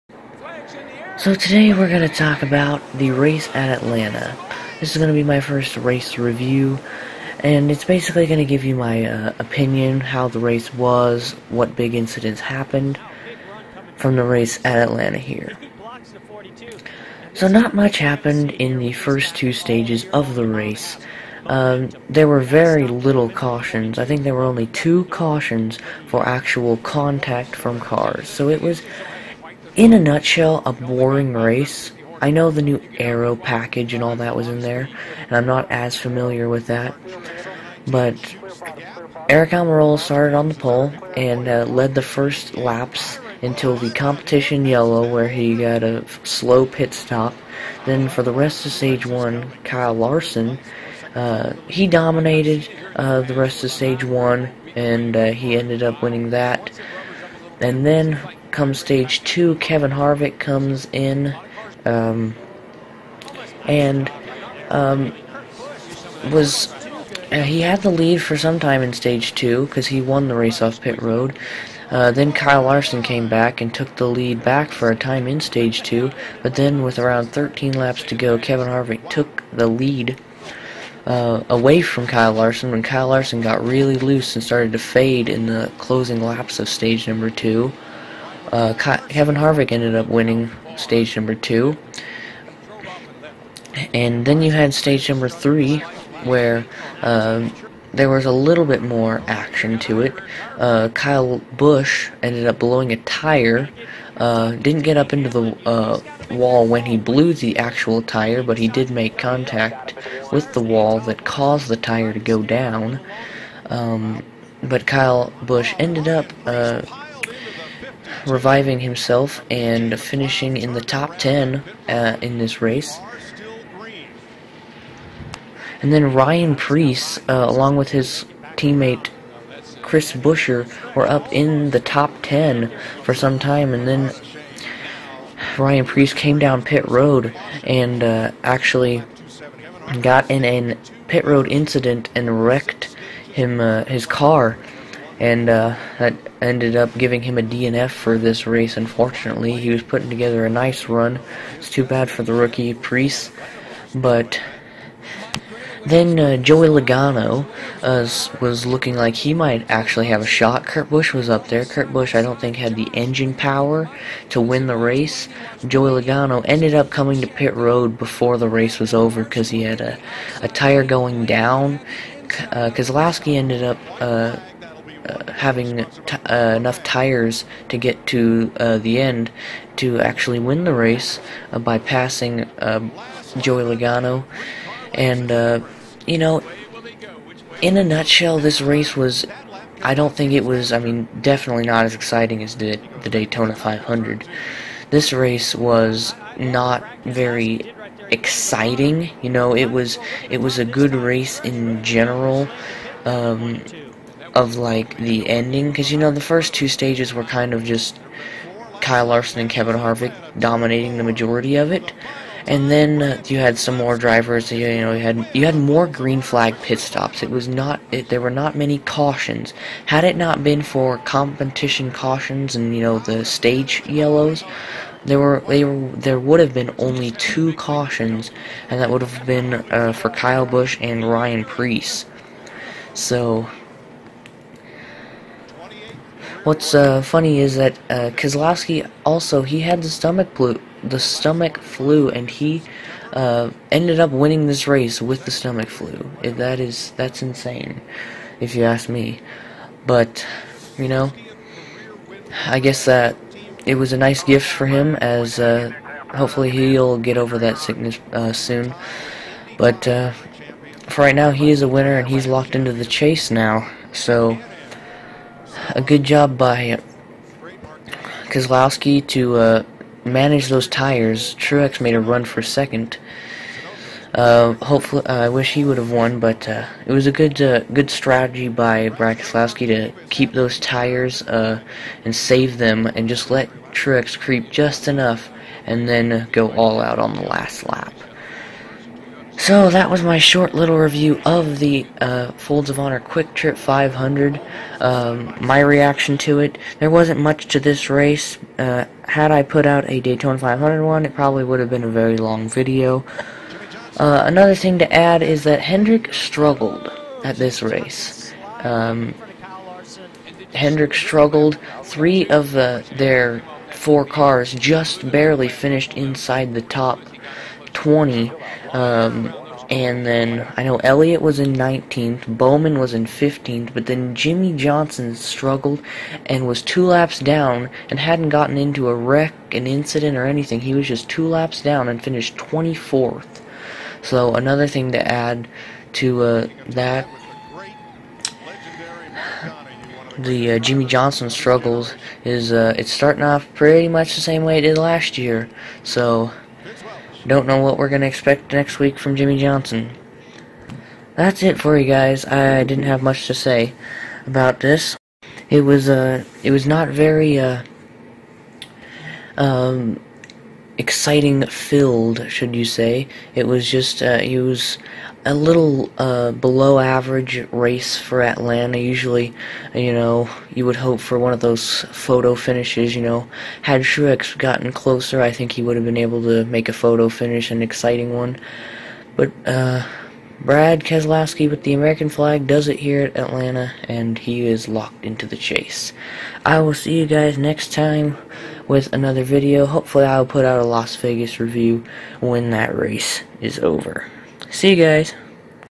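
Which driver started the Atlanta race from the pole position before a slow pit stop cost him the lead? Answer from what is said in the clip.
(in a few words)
Eric Almirola.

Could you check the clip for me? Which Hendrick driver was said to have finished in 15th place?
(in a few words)
Bowman.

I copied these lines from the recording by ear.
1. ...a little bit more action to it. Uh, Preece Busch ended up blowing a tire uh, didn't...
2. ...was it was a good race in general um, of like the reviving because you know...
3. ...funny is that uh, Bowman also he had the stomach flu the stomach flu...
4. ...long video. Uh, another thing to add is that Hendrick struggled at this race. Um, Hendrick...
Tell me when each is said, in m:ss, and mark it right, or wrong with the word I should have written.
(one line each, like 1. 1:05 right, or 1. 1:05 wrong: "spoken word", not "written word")
1. 1:38 wrong: "Kyle", not "Preece"
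2. 3:19 wrong: "ending", not "reviving"
3. 3:57 wrong: "Keselowski", not "Bowman"
4. 5:02 right.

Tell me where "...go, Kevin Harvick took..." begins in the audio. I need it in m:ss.
1:18.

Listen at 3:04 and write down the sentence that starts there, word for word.
And, uh, you know, in a nutshell, this race was.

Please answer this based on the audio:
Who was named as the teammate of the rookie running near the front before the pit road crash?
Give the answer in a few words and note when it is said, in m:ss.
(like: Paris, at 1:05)
Chris Buescher, at 2:09.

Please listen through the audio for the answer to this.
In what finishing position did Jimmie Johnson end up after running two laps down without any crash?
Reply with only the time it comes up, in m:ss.
5:32.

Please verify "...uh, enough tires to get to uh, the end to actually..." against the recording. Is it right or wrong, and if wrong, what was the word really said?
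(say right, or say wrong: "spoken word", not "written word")
right.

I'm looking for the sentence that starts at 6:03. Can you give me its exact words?
It was just uh, it was a little uh, below average race for Atlanta.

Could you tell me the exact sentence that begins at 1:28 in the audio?
Uh, Kevin Harvick ended up winning stage number two.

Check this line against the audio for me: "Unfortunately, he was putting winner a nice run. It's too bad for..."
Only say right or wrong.
wrong.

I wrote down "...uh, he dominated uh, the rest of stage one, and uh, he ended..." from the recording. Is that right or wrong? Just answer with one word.
right.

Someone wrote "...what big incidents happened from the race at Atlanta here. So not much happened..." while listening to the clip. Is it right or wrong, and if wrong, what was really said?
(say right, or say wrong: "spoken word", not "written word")
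right.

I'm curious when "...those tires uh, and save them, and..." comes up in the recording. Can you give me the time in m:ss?
4:40.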